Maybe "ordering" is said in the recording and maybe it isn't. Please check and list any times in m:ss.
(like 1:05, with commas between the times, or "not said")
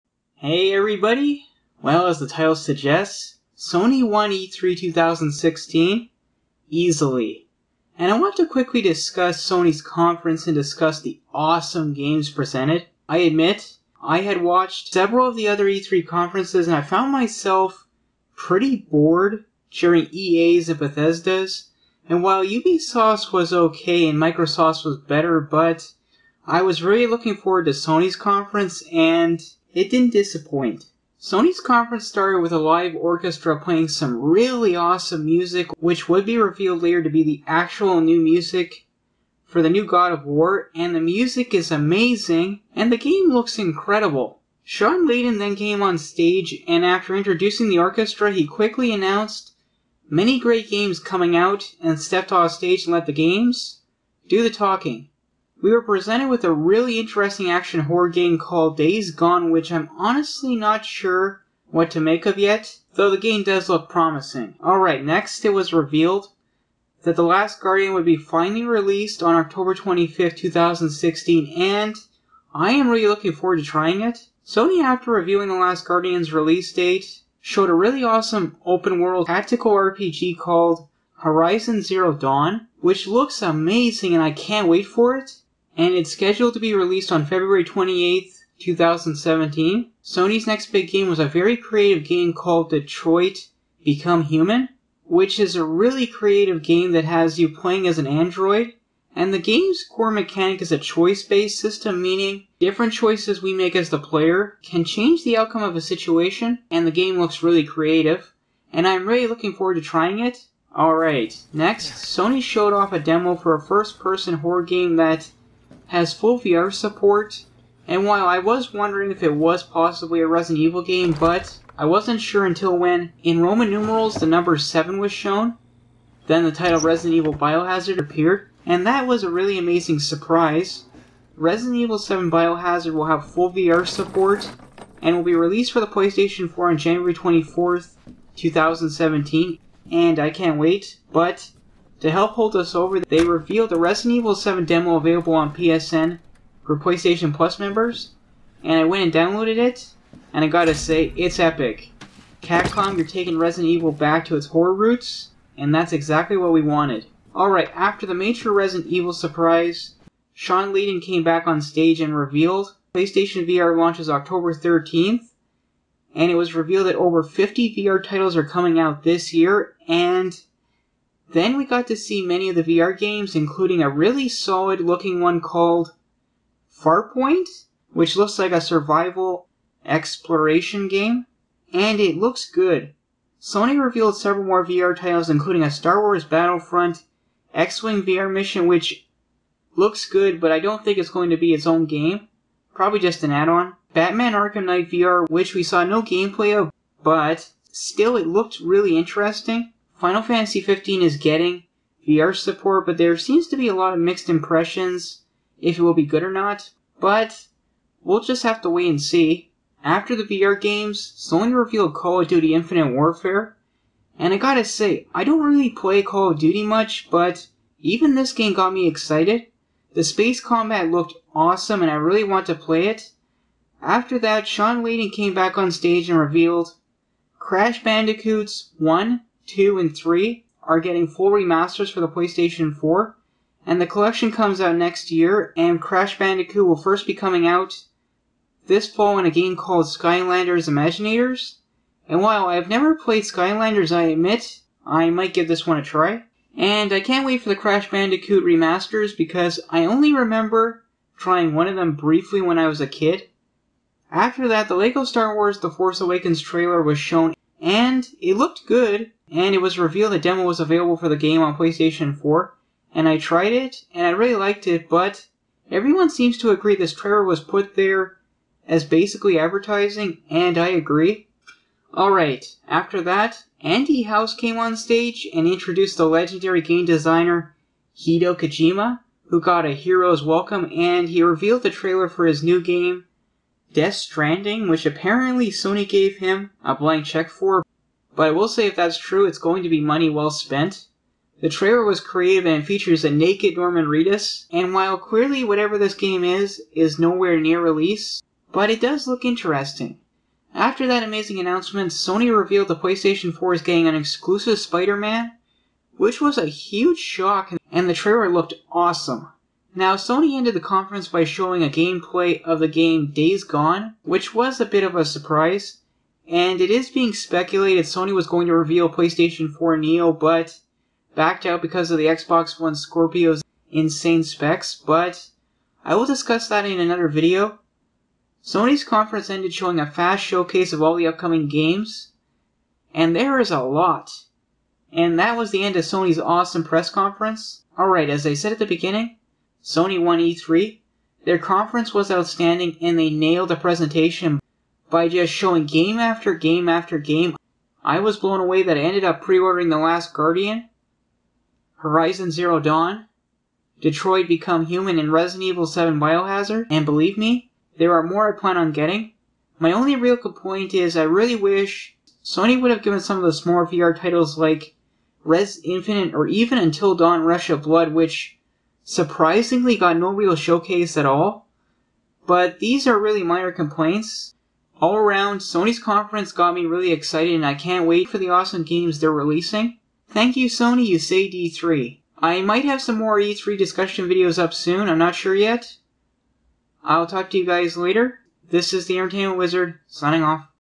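5:49.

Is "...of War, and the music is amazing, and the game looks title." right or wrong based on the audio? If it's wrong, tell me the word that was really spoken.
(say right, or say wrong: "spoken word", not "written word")
wrong: "incredible", not "title".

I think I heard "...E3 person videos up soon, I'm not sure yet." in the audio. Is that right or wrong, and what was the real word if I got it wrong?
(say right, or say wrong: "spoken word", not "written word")
wrong: "discussion", not "person".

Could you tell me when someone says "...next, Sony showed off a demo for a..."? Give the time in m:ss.
1:51.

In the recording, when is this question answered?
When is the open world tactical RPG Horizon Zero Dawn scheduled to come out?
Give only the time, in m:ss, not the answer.
1:27.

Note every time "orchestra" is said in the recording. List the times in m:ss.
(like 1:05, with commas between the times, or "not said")
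0:32, 0:47.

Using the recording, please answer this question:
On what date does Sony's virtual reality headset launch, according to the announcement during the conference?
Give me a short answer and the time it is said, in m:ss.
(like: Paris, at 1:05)
October 13th, at 2:44.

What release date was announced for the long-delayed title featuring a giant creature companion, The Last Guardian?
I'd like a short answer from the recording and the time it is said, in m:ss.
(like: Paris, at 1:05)
October 25th, 2016, at 1:09.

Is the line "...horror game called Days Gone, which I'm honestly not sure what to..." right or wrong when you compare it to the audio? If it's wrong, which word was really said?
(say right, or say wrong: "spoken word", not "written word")
right.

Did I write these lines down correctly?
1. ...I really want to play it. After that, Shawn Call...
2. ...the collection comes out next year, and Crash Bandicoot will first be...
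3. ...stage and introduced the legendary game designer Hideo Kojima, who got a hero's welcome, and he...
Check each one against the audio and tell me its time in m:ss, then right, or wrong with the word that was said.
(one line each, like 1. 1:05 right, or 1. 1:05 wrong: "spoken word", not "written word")
1. 3:41 wrong: "Layden", not "Call"
2. 3:53 right
3. 4:34 right.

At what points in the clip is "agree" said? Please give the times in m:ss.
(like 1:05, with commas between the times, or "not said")
4:26, 4:30.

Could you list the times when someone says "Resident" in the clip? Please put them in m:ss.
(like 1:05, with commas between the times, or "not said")
2:00, 2:06, 2:11, 2:23, 2:33, 2:38, 5:55.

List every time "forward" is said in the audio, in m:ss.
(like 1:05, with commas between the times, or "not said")
0:27, 1:13, 1:49.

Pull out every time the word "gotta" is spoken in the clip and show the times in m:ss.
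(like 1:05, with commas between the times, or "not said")
2:30, 3:34.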